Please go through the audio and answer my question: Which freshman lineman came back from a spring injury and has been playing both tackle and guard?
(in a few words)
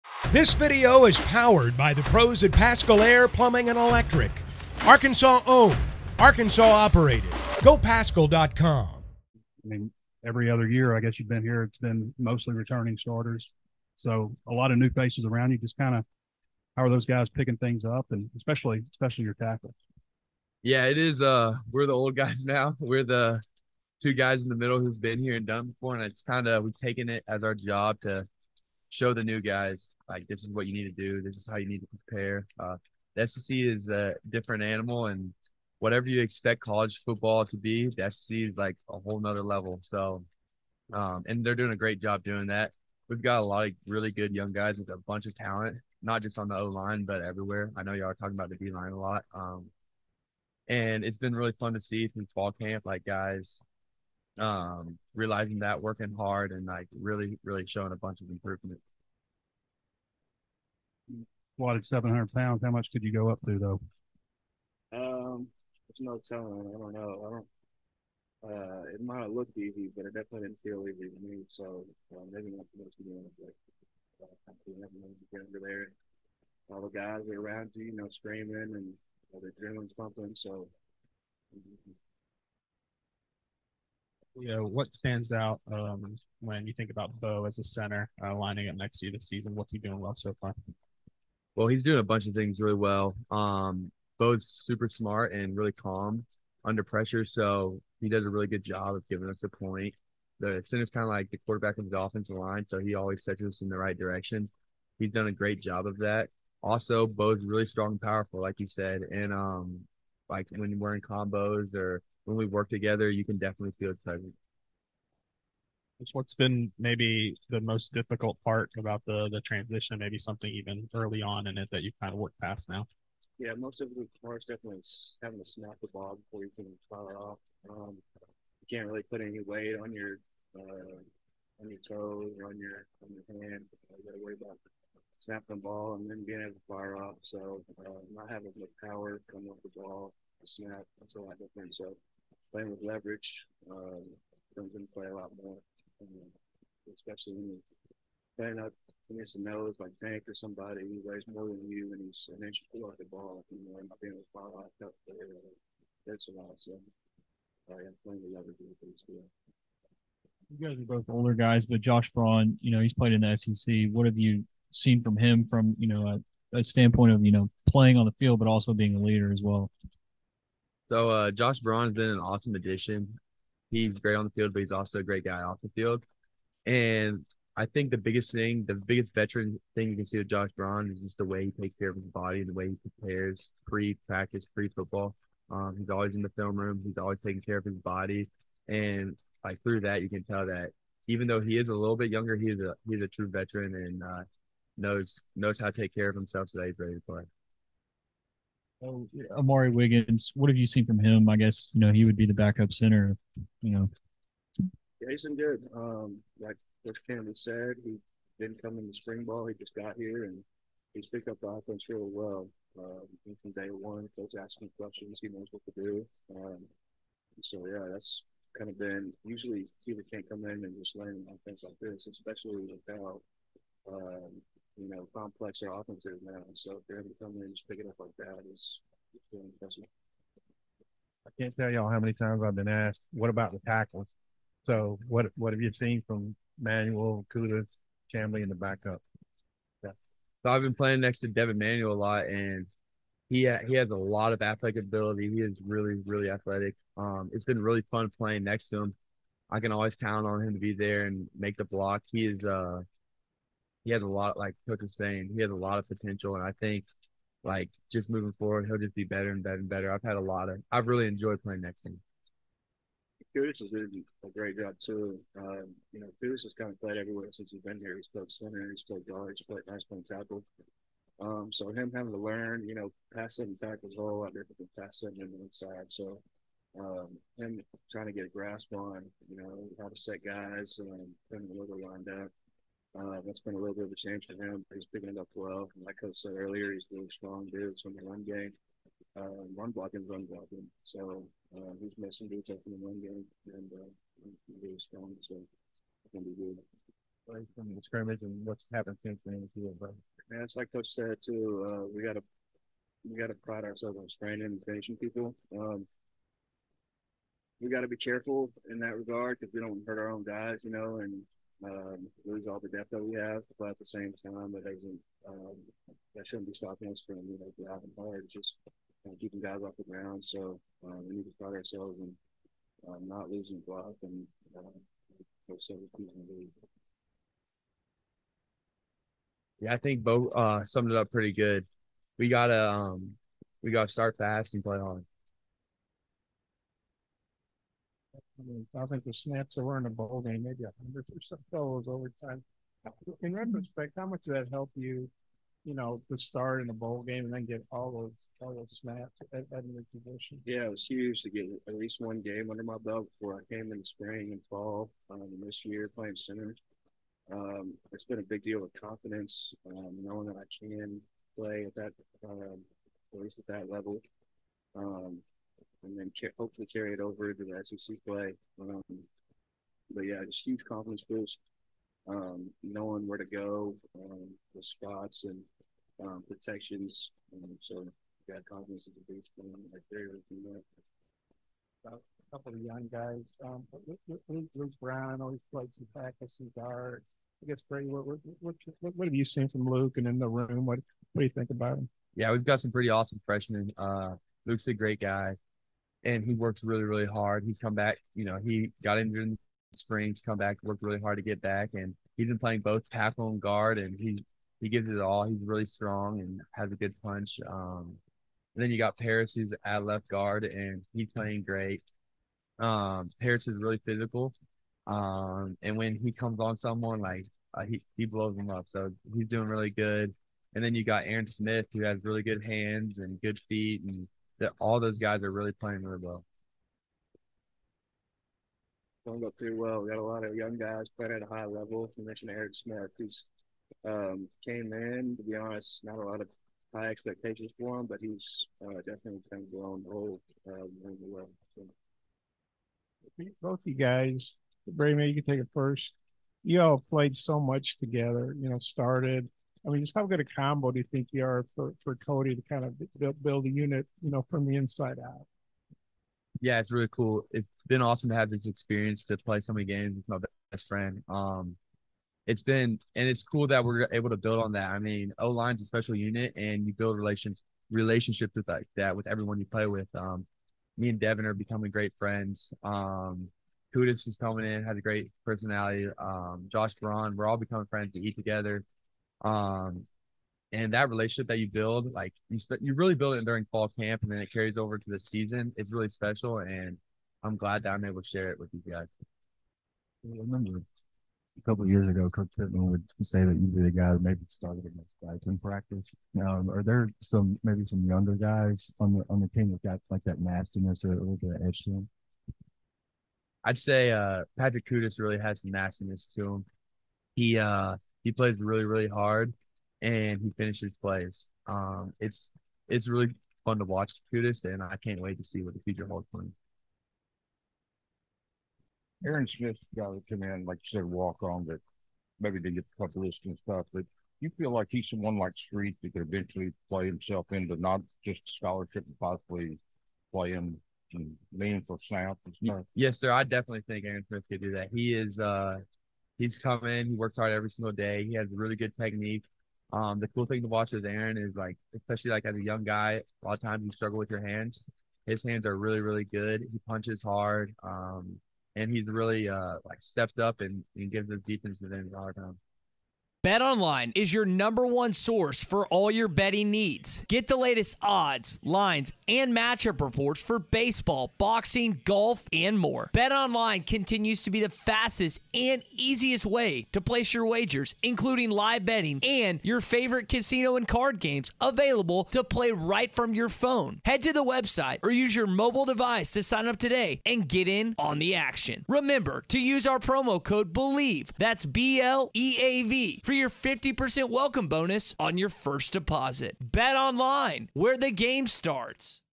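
Luke Brown.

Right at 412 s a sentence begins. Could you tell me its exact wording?
Um, Paris is really physical, um, and when he comes on someone, like uh, he he blows them up.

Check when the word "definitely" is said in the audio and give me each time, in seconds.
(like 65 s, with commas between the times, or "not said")
70 s, 113 s, 124 s, 438 s, 533 s.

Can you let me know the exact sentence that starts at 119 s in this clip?
Maybe something even early on in it that you've kind of worked past now.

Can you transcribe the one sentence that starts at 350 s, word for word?
Yeah, it was huge to get at least one game under my belt before I came in the spring and fall.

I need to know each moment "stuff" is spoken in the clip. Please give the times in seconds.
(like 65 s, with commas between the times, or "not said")
523 s, 532 s.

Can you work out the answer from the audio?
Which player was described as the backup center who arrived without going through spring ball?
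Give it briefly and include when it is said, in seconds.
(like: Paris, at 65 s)
Amari Wiggins, at 199 s.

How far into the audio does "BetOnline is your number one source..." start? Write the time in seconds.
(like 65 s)
553 s.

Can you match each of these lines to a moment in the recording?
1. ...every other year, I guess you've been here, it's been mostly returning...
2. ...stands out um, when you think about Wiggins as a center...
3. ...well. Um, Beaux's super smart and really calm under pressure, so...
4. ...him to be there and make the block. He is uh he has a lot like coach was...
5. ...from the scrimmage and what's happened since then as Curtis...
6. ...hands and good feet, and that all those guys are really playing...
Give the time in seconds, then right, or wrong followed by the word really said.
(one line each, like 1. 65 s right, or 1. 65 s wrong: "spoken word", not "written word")
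1. 10 s right
2. 84 s wrong: "Beaux", not "Wiggins"
3. 92 s right
4. 250 s right
5. 297 s wrong: "Yeah", not "Curtis"
6. 422 s right.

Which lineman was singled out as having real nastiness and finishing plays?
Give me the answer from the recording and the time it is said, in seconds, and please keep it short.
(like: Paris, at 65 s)
Patrick Kutas, at 504 s.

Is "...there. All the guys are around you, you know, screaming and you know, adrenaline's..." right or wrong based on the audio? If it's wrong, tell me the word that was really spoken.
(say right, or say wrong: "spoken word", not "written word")
right.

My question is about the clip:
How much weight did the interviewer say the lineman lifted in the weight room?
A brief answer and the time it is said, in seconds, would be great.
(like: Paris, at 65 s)
700 pounds, at 61 s.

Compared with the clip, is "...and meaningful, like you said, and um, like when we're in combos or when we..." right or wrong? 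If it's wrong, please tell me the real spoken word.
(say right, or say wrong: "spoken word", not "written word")
wrong: "powerful", not "meaningful".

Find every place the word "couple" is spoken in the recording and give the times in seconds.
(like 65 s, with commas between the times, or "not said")
382 s, 491 s, 522 s.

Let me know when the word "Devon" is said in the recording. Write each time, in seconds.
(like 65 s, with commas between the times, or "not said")
241 s, 470 s.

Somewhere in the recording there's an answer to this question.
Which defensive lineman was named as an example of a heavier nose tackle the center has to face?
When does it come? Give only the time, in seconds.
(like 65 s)
150 s.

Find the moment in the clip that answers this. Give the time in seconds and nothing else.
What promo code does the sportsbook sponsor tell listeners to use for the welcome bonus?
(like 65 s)
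580 s.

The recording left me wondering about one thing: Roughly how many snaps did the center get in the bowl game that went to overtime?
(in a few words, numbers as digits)
100.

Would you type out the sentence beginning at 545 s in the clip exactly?
His hands are really, really good.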